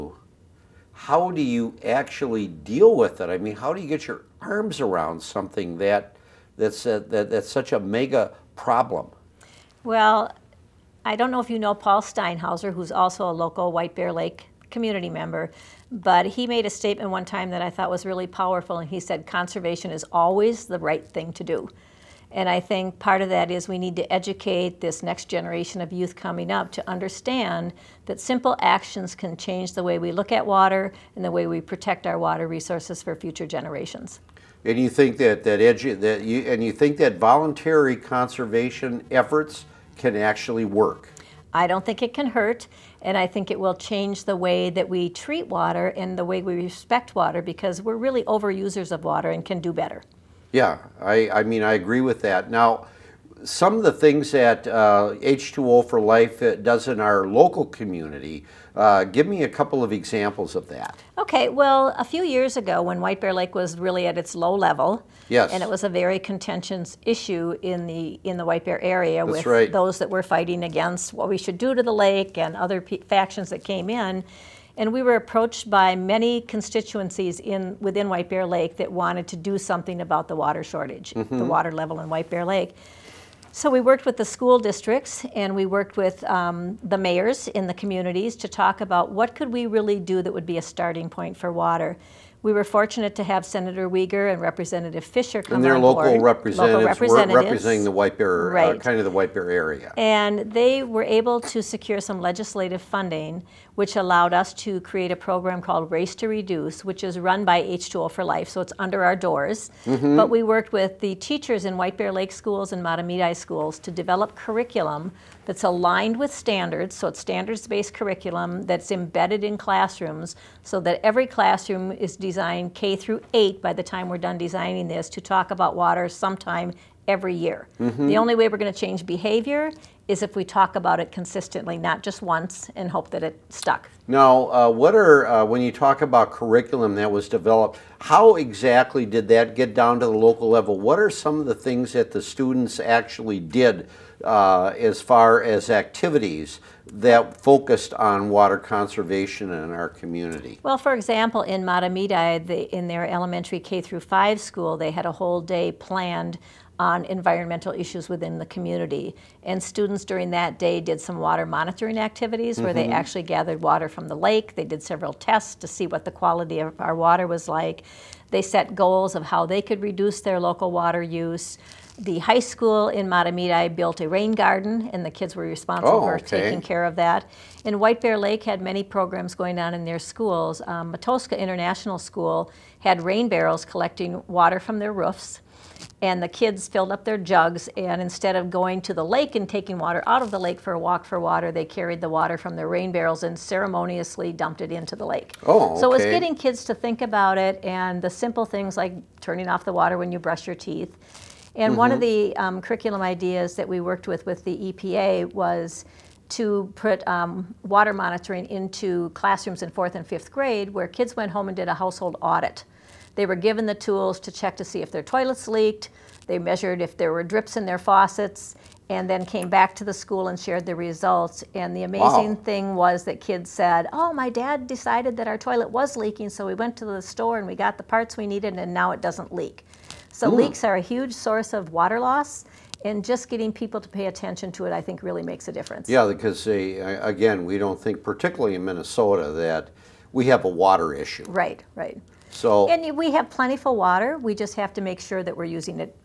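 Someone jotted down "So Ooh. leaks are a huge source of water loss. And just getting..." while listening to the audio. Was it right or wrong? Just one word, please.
right.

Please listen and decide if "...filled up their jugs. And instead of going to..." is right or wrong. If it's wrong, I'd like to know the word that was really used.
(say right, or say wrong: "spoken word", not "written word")
right.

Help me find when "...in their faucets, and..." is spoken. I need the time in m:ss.
3:37.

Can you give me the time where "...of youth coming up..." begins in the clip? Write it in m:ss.
0:25.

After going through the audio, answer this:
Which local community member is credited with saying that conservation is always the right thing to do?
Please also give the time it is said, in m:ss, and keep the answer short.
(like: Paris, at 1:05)
Paul Steinhauser, at 0:11.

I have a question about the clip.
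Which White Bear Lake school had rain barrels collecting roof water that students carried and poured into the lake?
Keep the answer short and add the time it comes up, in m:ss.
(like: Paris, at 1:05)
Matoska International School, at 3:00.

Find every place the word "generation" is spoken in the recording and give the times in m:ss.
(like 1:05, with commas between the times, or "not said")
0:25, 0:33.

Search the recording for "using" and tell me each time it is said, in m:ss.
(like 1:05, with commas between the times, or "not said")
4:05.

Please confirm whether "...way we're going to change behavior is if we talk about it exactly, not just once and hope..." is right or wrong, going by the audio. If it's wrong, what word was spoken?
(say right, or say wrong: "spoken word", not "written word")
wrong: "consistently", not "exactly".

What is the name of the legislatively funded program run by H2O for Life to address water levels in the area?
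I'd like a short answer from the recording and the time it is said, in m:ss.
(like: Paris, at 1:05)
Race to Reduce, at 1:45.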